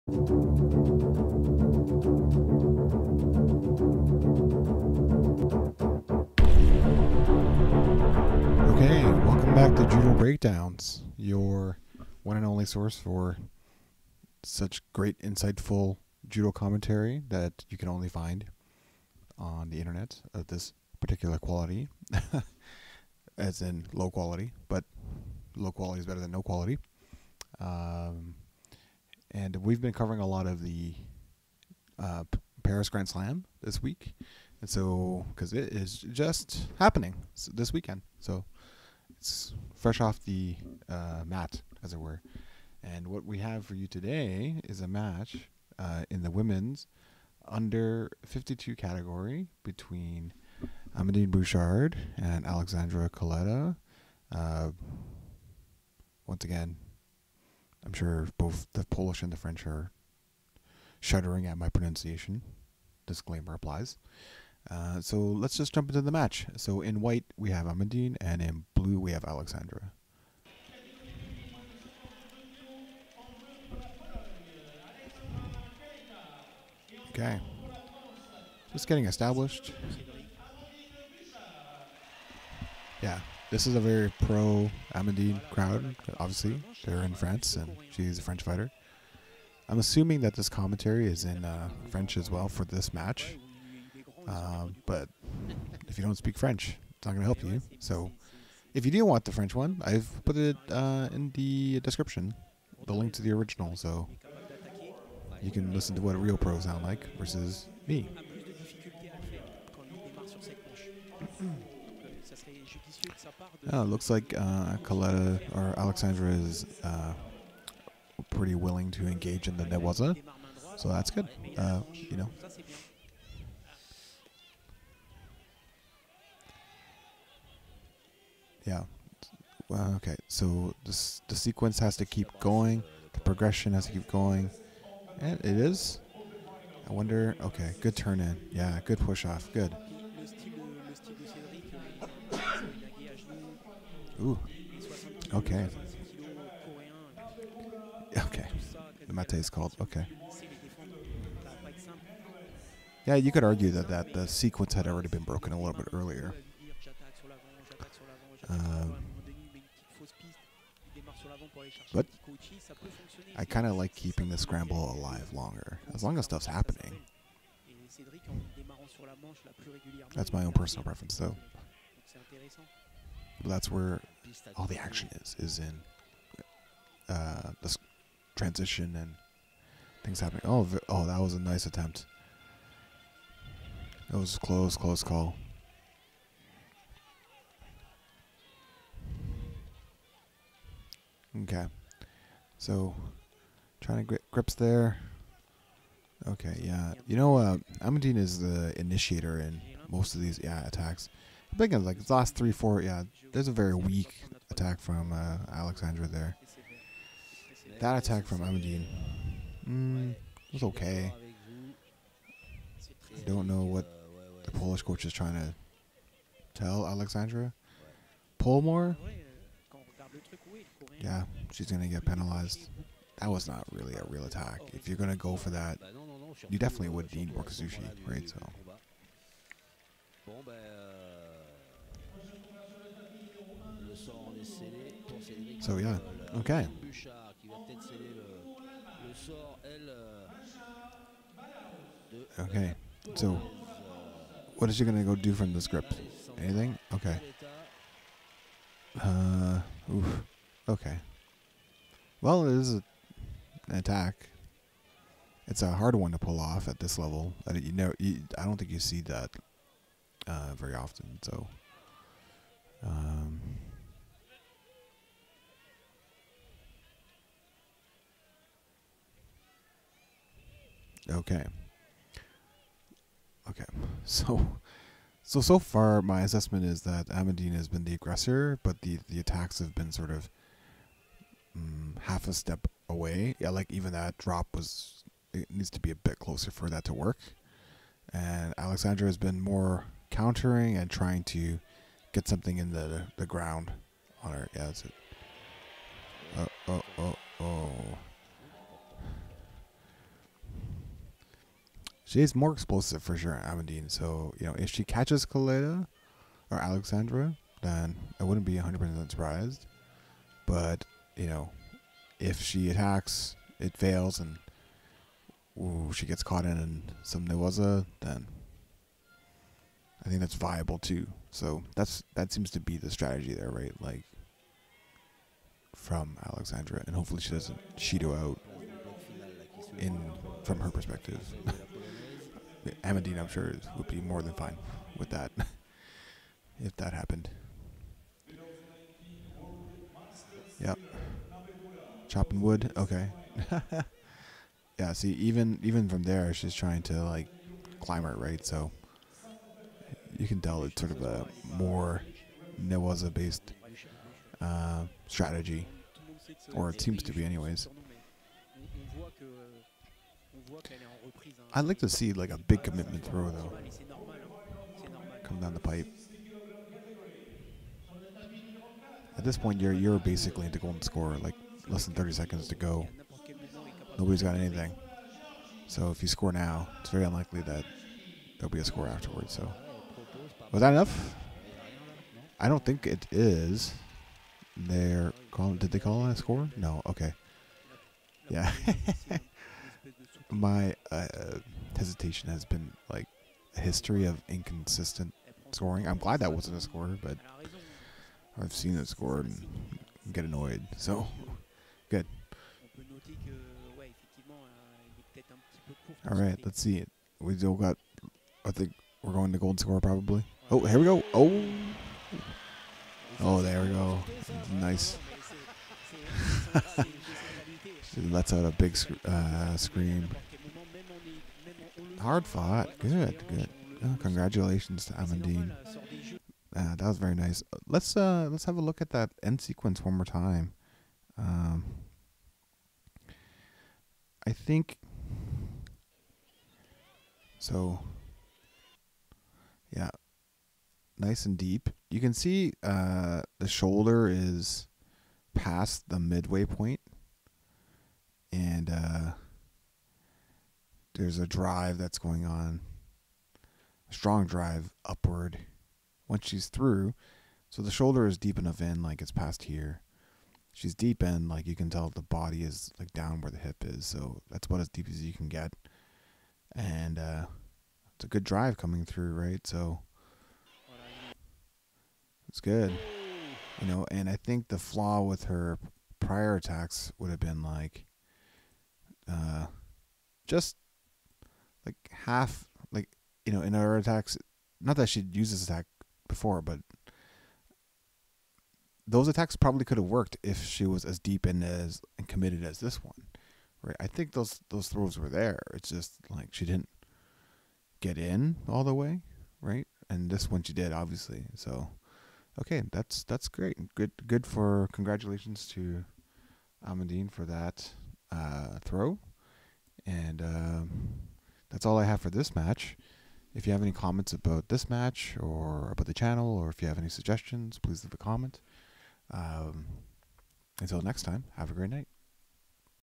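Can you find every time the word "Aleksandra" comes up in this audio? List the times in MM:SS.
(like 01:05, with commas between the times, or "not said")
00:52, 01:09, 01:55, 03:25, 03:36, 04:48, 05:06, 05:26.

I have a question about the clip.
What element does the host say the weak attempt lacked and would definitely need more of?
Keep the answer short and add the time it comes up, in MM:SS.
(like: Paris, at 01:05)
Kazushi, at 03:47.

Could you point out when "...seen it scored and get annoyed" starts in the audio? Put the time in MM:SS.
06:38.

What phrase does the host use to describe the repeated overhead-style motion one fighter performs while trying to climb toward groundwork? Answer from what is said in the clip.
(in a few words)
Chopping wood.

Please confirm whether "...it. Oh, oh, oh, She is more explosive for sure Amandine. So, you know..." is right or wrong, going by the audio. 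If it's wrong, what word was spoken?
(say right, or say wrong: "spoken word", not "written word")
right.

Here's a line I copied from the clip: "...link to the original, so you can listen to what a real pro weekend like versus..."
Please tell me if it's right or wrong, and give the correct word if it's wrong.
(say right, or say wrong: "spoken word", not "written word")
wrong: "sound", not "weekend".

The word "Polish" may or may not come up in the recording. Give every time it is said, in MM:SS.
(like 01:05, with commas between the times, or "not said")
00:58, 03:34.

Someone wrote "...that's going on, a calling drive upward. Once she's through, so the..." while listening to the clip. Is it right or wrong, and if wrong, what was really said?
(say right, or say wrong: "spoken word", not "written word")
wrong: "strong", not "calling".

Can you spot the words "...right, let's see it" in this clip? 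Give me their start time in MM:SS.
06:46.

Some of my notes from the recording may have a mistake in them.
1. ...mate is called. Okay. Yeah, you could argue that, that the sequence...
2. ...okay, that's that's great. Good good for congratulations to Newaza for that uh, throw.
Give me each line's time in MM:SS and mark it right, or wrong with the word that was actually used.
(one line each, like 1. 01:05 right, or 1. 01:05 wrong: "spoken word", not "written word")
1. 02:29 right
2. 08:22 wrong: "Amandine", not "Newaza".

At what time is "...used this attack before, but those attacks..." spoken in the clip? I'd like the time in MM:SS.
08:05.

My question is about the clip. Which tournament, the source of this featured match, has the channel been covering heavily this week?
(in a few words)
Paris Grand Slam.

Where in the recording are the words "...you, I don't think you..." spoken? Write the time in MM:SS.
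04:17.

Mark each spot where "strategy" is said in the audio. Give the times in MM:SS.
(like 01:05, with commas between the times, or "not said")
05:22, 05:55.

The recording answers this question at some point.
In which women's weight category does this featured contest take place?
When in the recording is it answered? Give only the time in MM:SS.
00:47.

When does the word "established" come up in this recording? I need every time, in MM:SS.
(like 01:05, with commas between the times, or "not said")
01:19.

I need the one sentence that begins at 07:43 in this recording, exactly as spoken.
So that's about as deep as you can get, and uh, it's a good drive coming through, right?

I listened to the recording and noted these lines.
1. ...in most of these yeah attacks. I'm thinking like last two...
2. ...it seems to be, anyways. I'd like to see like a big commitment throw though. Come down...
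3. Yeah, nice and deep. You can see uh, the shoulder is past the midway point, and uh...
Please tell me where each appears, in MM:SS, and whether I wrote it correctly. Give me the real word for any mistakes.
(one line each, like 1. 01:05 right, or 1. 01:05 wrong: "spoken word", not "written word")
1. 03:19 wrong: "three", not "two"
2. 05:56 right
3. 07:19 right.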